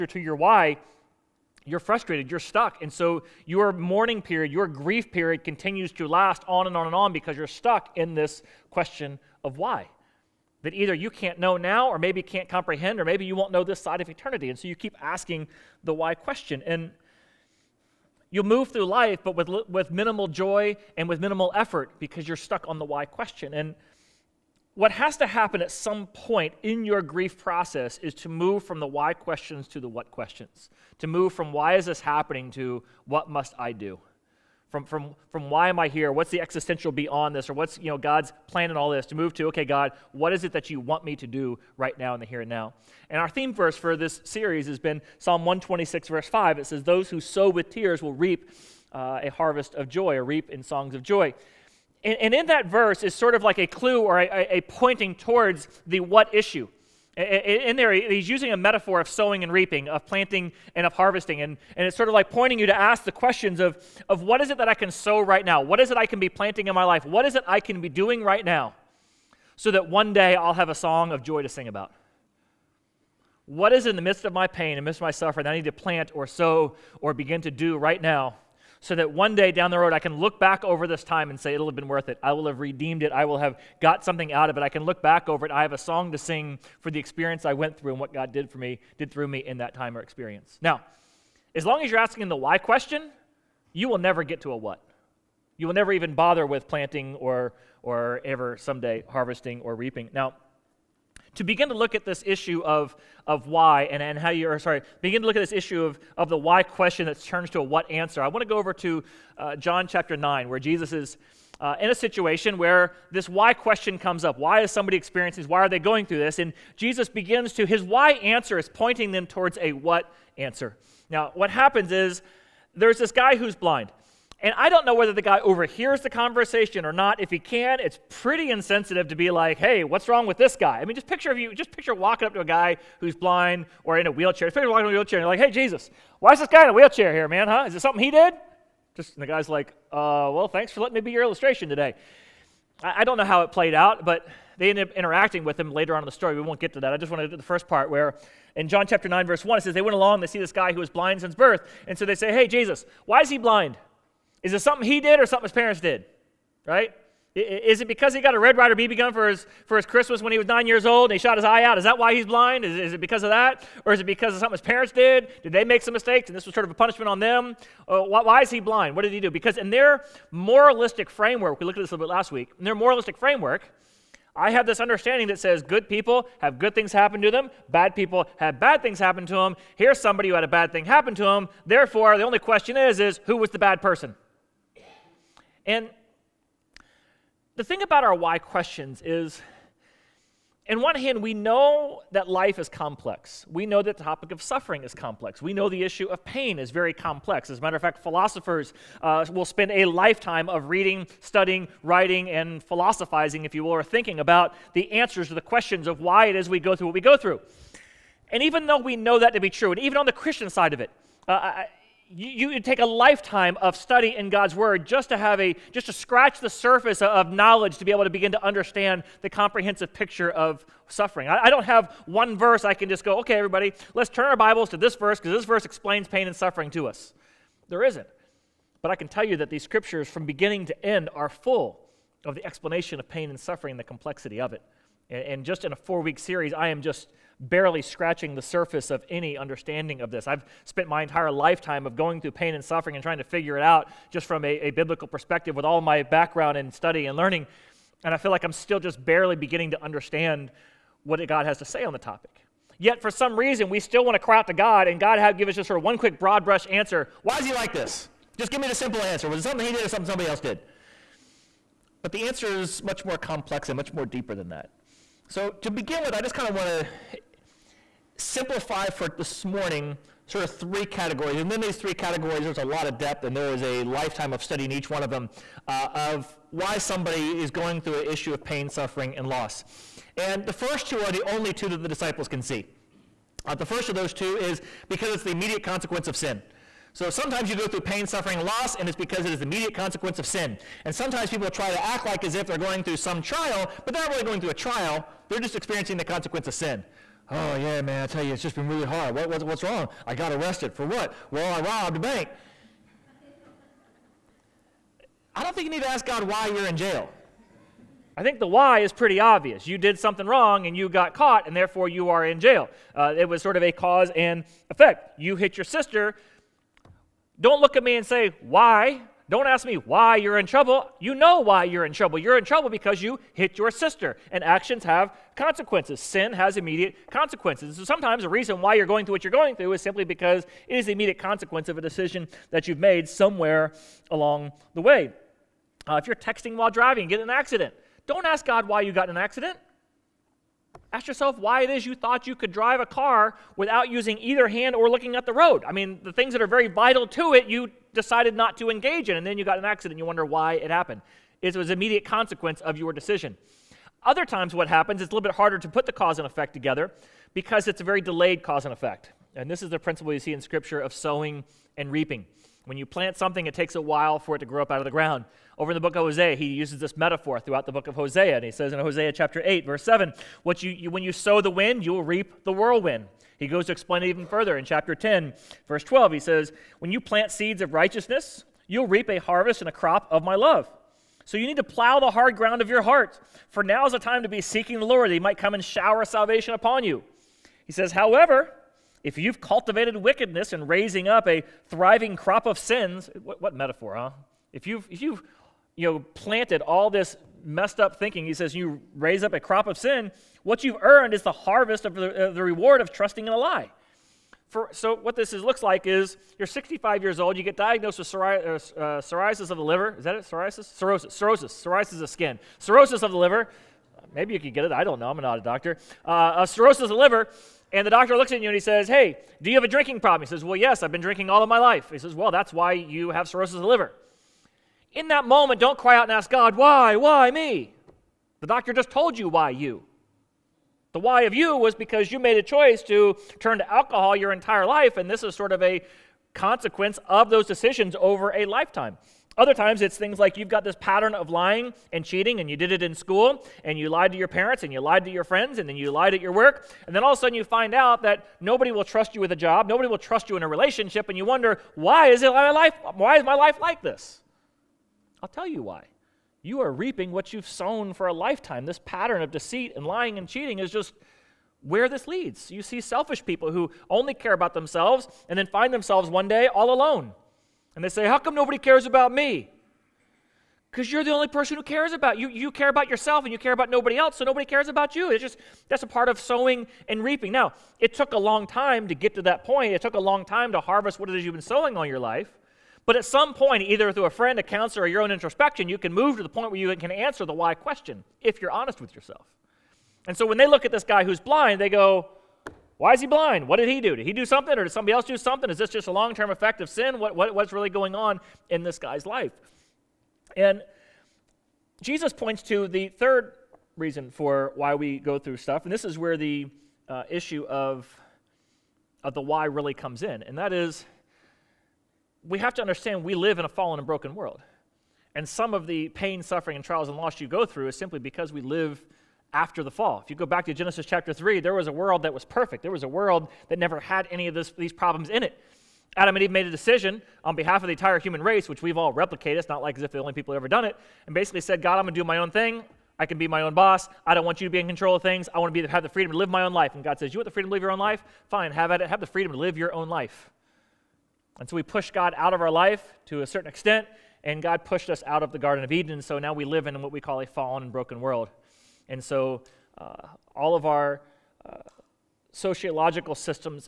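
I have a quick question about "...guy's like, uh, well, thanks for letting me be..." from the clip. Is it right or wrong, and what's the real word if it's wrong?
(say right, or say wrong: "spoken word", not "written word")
right.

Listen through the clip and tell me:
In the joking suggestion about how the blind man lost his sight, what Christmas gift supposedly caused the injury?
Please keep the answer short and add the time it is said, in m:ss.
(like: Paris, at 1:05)
Red Rider BB gun, at 2:38.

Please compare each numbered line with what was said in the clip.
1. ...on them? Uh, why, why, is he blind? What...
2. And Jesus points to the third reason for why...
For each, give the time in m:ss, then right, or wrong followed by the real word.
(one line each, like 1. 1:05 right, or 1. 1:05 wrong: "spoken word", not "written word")
1. 2:47 right
2. 8:20 right.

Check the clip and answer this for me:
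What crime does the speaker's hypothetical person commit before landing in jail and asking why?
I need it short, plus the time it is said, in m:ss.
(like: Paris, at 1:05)
Robbed a bank, at 5:01.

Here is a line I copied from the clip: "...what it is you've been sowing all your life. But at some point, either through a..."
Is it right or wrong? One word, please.
right.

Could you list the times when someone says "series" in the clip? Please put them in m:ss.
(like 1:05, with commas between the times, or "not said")
0:44, 3:56.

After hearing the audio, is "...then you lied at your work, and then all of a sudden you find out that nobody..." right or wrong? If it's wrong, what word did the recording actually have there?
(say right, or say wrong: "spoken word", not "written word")
right.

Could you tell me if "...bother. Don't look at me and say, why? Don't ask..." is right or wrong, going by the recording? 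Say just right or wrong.
wrong.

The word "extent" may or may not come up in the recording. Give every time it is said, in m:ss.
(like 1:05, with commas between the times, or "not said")
9:03.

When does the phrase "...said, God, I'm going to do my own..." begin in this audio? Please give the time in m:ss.
8:51.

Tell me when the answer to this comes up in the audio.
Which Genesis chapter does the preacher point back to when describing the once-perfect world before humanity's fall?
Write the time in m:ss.
8:40.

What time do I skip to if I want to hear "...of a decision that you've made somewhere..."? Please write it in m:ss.
5:31.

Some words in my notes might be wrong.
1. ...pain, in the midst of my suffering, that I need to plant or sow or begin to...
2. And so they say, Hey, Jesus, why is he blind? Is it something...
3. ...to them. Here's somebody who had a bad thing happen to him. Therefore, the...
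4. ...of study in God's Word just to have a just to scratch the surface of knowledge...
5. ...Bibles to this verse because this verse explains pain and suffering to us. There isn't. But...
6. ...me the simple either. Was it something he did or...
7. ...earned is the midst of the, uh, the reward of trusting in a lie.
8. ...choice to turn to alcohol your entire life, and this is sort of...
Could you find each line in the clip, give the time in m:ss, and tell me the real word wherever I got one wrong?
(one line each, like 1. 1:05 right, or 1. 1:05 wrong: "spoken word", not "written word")
1. 1:14 right
2. 2:31 right
3. 2:59 right
4. 3:33 right
5. 3:44 right
6. 4:18 wrong: "answer", not "either"
7. 6:40 wrong: "harvest", not "midst"
8. 7:12 right.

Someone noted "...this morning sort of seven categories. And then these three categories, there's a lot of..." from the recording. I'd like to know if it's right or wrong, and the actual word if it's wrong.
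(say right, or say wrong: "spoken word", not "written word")
wrong: "three", not "seven".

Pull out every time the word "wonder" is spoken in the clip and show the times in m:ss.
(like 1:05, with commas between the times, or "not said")
5:50, 7:31.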